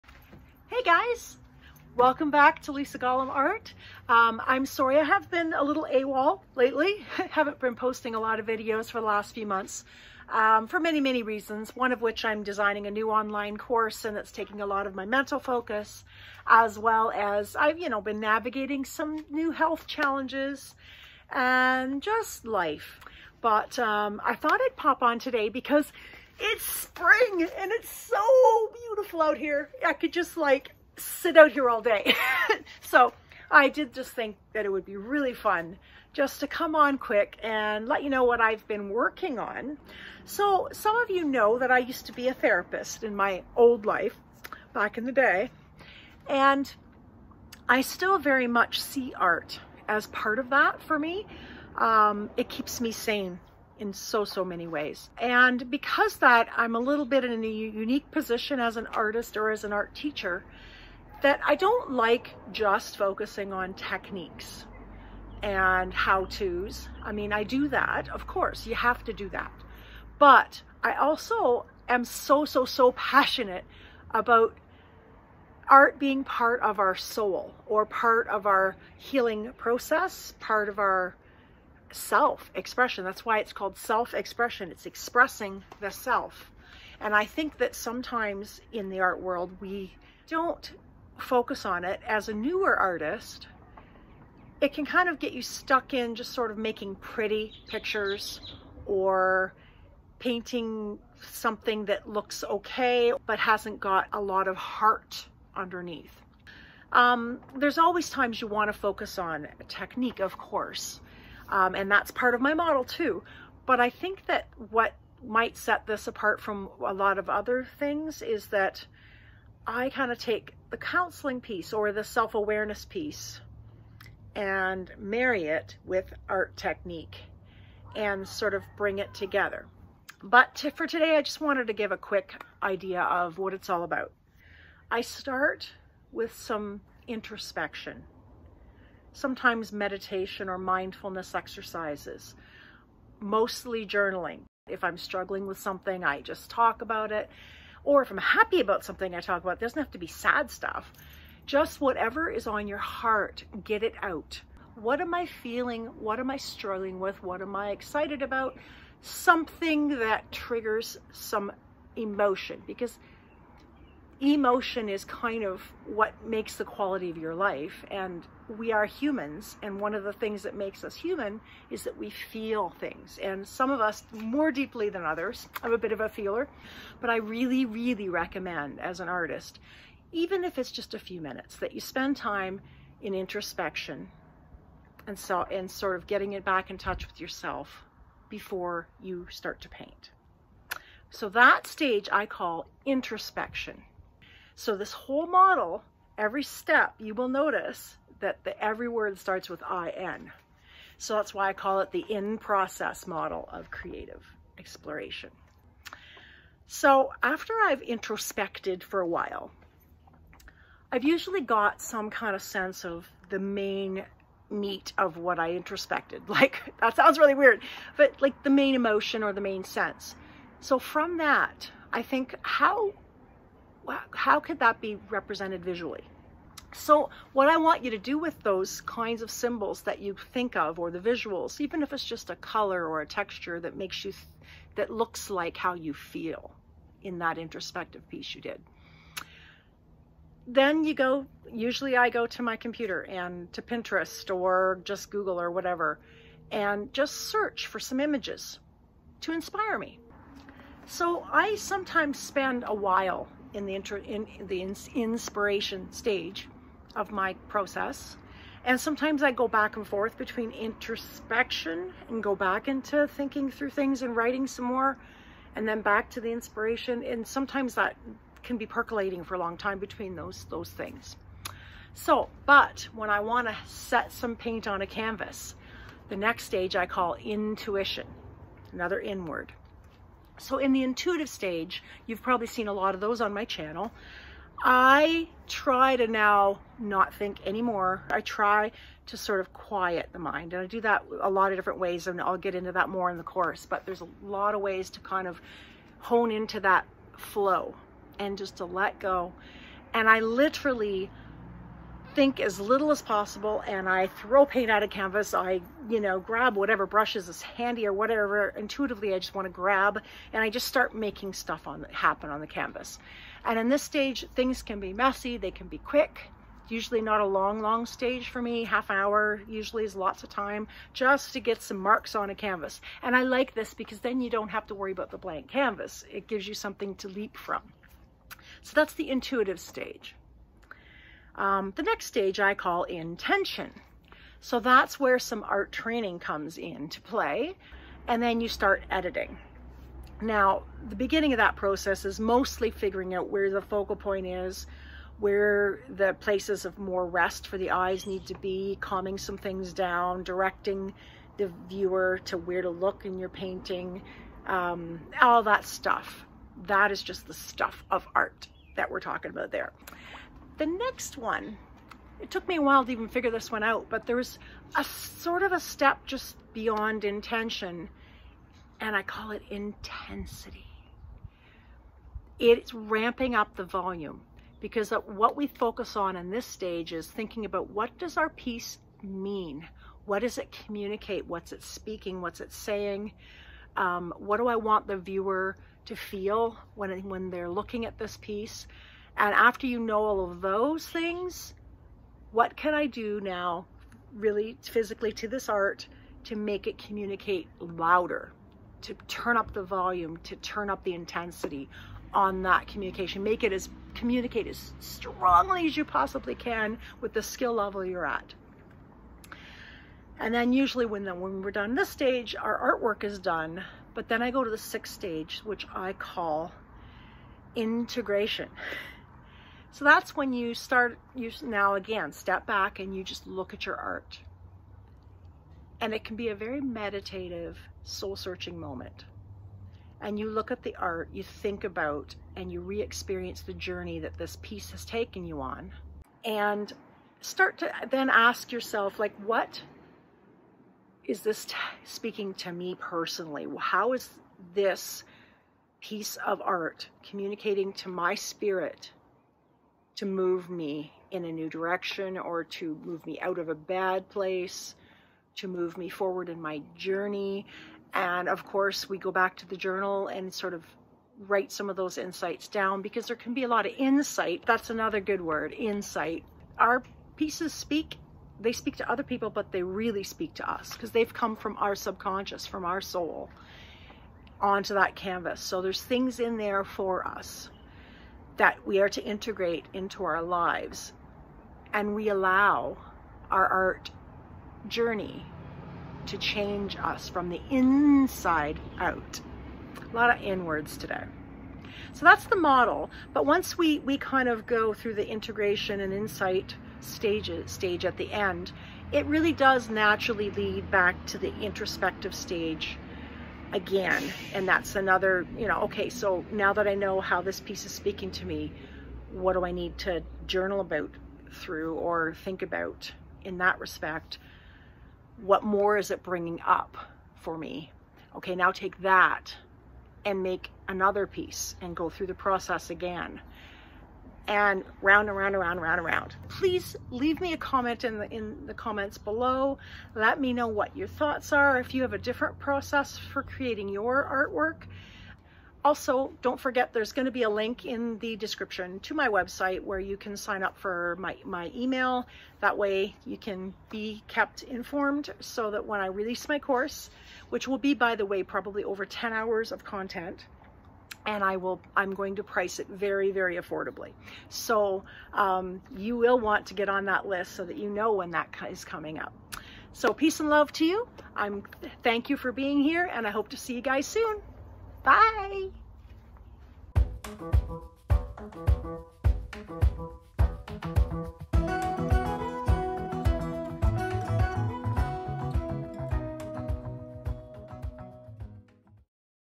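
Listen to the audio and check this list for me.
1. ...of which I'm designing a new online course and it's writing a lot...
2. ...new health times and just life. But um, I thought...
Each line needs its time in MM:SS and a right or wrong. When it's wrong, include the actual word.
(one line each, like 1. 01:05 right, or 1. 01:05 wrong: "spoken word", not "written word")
1. 00:11 wrong: "taking", not "writing"
2. 00:19 wrong: "challenges", not "times".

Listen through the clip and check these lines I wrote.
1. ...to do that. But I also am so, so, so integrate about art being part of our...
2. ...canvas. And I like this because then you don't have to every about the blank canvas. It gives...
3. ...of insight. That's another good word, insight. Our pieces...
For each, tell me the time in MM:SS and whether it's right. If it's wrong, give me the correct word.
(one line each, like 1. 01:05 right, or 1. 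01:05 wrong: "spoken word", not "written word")
1. 01:09 wrong: "passionate", not "integrate"
2. 05:22 wrong: "worry", not "every"
3. 07:43 right.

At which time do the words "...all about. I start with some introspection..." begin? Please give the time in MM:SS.
02:13.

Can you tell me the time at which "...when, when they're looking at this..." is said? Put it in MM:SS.
06:26.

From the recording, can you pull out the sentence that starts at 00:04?
Um, I'm sorry I have been a little AWOL lately.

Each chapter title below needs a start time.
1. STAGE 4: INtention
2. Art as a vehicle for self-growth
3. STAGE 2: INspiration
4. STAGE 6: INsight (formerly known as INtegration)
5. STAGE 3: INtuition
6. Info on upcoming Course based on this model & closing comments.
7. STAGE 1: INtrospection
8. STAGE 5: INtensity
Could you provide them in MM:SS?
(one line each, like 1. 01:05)
1. 05:31
2. 01:40
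3. 03:26
4. 06:49
5. 04:31
6. 08:45
7. 02:14
8. 06:00.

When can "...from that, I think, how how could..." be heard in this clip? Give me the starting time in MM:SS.
03:40.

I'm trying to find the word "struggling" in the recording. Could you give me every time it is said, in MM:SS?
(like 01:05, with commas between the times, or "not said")
02:24, 02:36.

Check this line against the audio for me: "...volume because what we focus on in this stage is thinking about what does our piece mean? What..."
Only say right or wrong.
right.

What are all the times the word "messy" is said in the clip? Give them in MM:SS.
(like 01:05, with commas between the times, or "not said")
05:14.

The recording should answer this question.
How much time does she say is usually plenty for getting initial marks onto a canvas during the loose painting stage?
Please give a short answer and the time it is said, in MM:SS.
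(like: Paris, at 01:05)
Half an hour, at 05:18.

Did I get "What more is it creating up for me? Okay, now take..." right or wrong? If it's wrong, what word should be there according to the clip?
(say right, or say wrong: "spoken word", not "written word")
wrong: "bringing", not "creating".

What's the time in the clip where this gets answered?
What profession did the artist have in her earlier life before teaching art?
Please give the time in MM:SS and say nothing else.
00:42.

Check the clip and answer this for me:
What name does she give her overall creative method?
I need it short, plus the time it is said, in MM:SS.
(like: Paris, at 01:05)
In-process model of creative exploration, at 03:22.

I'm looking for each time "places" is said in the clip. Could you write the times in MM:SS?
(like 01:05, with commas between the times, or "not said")
05:46, 07:34.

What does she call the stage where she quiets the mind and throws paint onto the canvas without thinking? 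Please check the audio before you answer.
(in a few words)
Intuition.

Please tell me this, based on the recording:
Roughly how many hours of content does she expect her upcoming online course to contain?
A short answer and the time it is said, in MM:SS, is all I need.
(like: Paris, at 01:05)
Over 10 hours, at 09:08.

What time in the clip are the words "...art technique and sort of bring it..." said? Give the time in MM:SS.
02:06.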